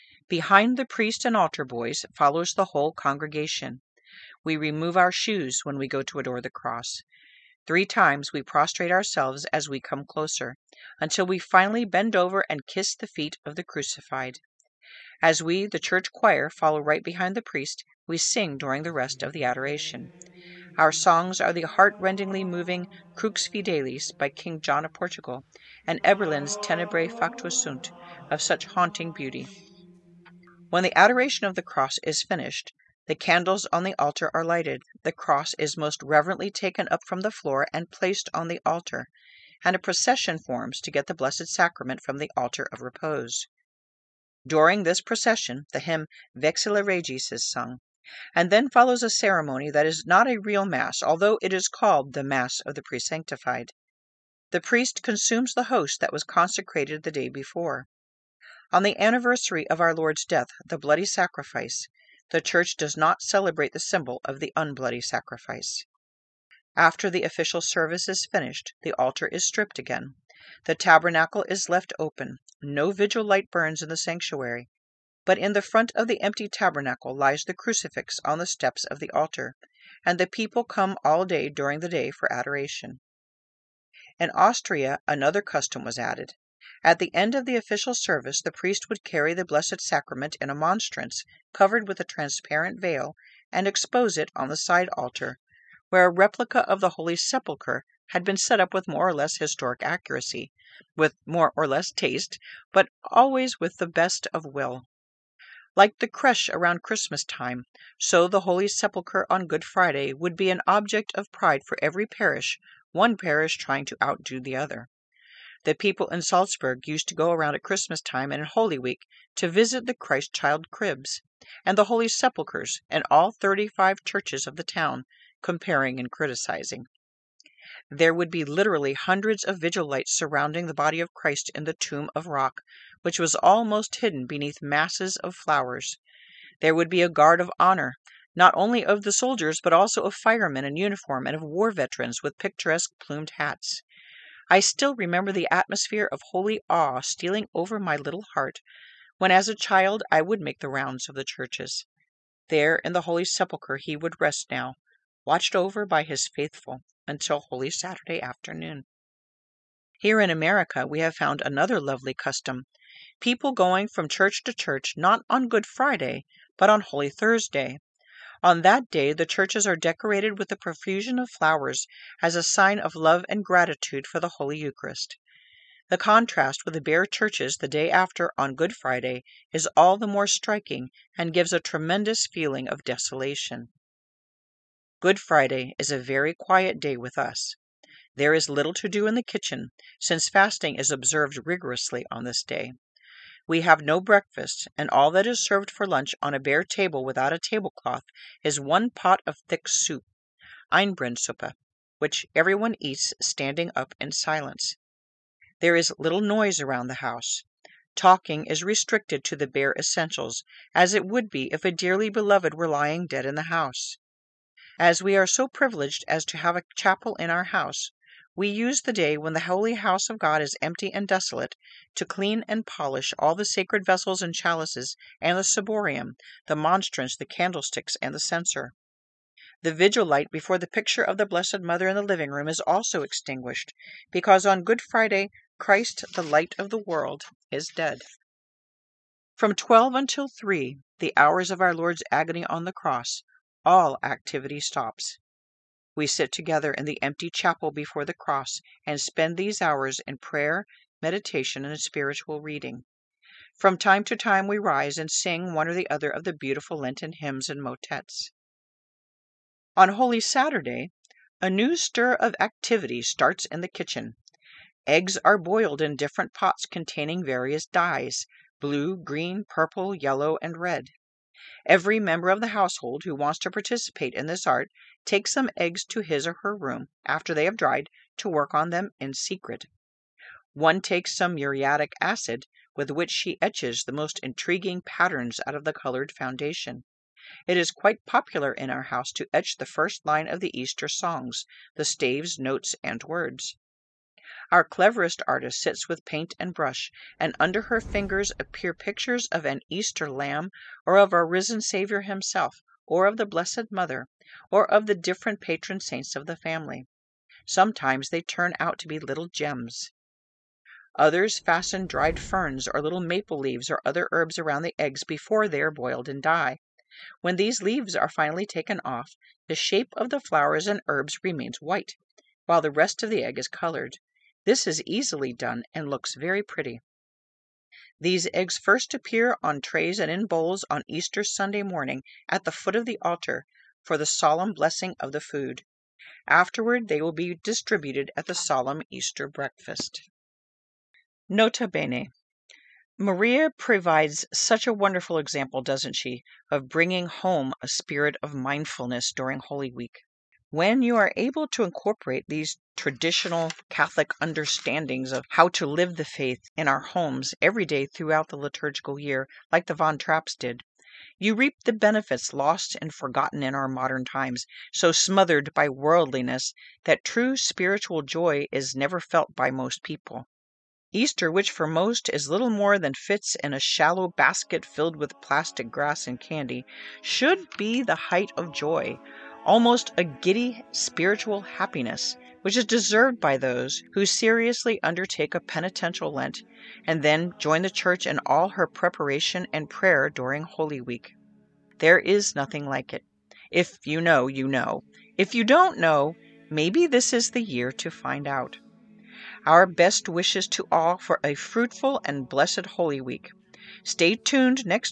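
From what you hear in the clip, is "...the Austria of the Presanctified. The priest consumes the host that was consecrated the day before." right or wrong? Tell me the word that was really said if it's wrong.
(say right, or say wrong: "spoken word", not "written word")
wrong: "Mass", not "Austria".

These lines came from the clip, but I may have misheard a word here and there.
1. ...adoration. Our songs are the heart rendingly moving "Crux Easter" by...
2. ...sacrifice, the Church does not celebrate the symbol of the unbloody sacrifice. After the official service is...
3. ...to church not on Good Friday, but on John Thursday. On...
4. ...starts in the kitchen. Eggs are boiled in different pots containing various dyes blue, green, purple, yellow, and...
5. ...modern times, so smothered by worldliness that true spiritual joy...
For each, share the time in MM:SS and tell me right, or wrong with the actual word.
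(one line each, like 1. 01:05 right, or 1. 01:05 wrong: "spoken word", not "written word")
1. 00:19 wrong: "Fidelis", not "Easter"
2. 01:01 right
3. 02:44 wrong: "Holy", not "John"
4. 04:23 right
5. 06:03 right.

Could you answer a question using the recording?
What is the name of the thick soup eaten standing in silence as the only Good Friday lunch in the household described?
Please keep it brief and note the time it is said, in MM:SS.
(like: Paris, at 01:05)
Einbrennsuppe, at 03:20.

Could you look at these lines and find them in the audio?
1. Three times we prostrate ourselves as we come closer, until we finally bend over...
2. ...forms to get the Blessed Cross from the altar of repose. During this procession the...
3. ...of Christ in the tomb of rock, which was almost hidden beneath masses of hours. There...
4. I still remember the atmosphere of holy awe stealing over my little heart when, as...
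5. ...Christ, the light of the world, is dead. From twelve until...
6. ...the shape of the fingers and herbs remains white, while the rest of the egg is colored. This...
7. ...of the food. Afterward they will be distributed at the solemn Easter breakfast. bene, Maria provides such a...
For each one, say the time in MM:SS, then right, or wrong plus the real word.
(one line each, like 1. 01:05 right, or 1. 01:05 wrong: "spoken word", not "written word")
1. 00:07 right
2. 00:40 wrong: "Sacrament", not "Cross"
3. 02:10 wrong: "flowers", not "hours"
4. 02:24 right
5. 03:55 right
6. 05:19 wrong: "flowers", not "fingers"
7. 05:34 right.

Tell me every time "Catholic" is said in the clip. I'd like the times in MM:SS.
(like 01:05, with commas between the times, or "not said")
05:53.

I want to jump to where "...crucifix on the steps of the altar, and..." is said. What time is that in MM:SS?
01:17.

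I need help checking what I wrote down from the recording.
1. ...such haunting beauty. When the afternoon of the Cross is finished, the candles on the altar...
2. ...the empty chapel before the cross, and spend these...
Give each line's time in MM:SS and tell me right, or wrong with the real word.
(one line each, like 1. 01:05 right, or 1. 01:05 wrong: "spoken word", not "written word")
1. 00:28 wrong: "adoration", not "afternoon"
2. 04:06 right.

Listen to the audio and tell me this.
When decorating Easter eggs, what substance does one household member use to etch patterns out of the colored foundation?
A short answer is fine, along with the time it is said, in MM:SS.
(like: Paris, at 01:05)
Muriatic acid, at 04:41.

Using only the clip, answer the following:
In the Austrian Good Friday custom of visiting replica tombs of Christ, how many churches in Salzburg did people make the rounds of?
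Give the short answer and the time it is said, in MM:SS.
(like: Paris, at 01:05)
35, at 02:03.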